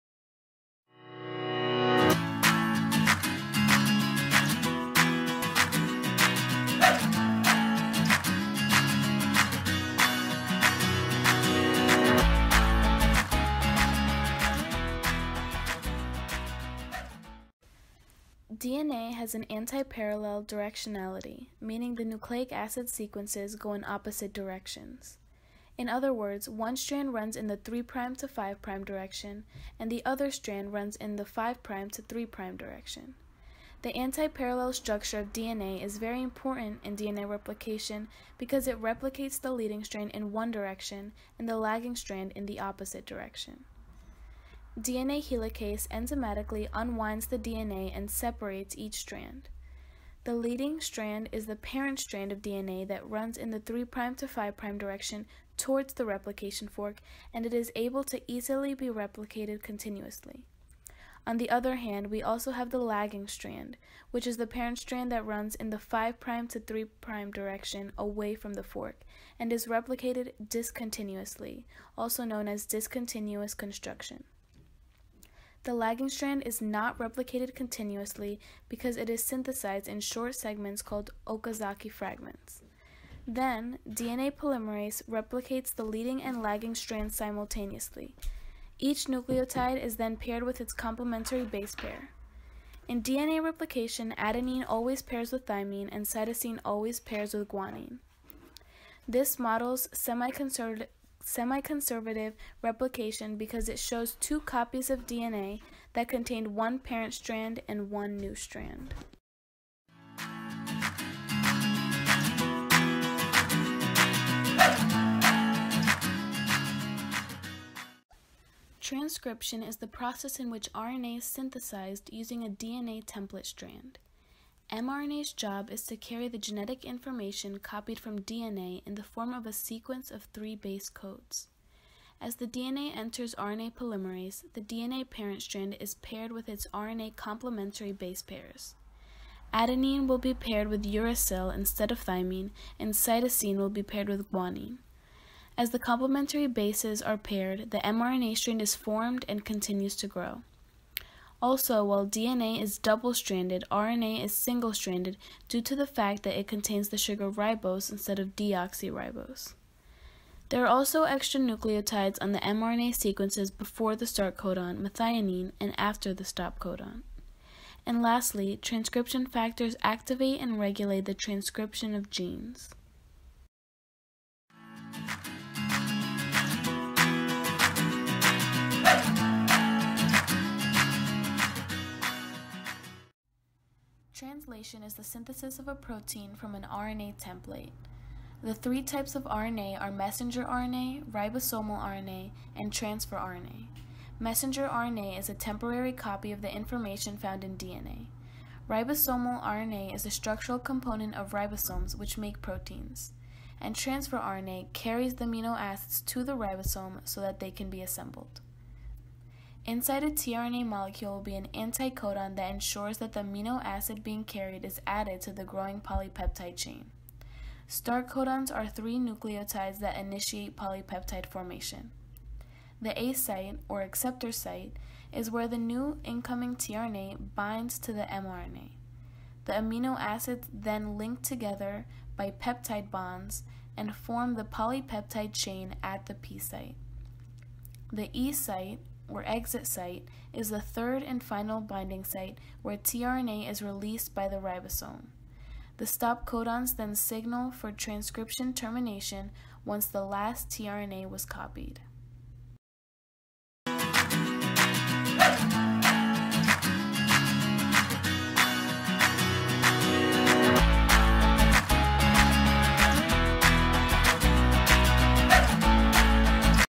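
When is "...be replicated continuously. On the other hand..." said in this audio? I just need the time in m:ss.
0:58.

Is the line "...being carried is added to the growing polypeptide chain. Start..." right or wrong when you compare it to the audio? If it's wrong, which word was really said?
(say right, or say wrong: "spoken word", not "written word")
right.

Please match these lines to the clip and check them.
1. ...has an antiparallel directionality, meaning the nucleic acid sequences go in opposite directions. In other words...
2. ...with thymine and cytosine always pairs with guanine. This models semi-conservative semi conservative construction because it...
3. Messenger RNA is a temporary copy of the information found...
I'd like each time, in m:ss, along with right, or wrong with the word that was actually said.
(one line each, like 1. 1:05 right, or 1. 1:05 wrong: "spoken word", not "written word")
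1. 0:19 right
2. 1:35 wrong: "replication", not "construction"
3. 3:14 right.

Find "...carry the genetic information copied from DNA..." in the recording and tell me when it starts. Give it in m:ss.
2:05.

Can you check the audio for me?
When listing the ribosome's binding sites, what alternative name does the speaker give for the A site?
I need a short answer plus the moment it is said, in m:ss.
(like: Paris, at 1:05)
acceptor site, at 3:43.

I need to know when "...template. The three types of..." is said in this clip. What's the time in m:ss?
3:07.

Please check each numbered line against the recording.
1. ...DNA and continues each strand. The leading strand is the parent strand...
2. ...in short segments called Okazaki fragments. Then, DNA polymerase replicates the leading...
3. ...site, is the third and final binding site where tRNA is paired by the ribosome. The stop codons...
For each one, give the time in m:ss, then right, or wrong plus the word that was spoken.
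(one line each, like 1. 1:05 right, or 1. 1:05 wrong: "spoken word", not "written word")
1. 0:47 wrong: "separates", not "continues"
2. 1:19 right
3. 3:59 wrong: "released", not "paired".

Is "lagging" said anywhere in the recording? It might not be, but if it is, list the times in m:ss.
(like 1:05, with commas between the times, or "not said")
0:41, 1:02, 1:15, 1:26.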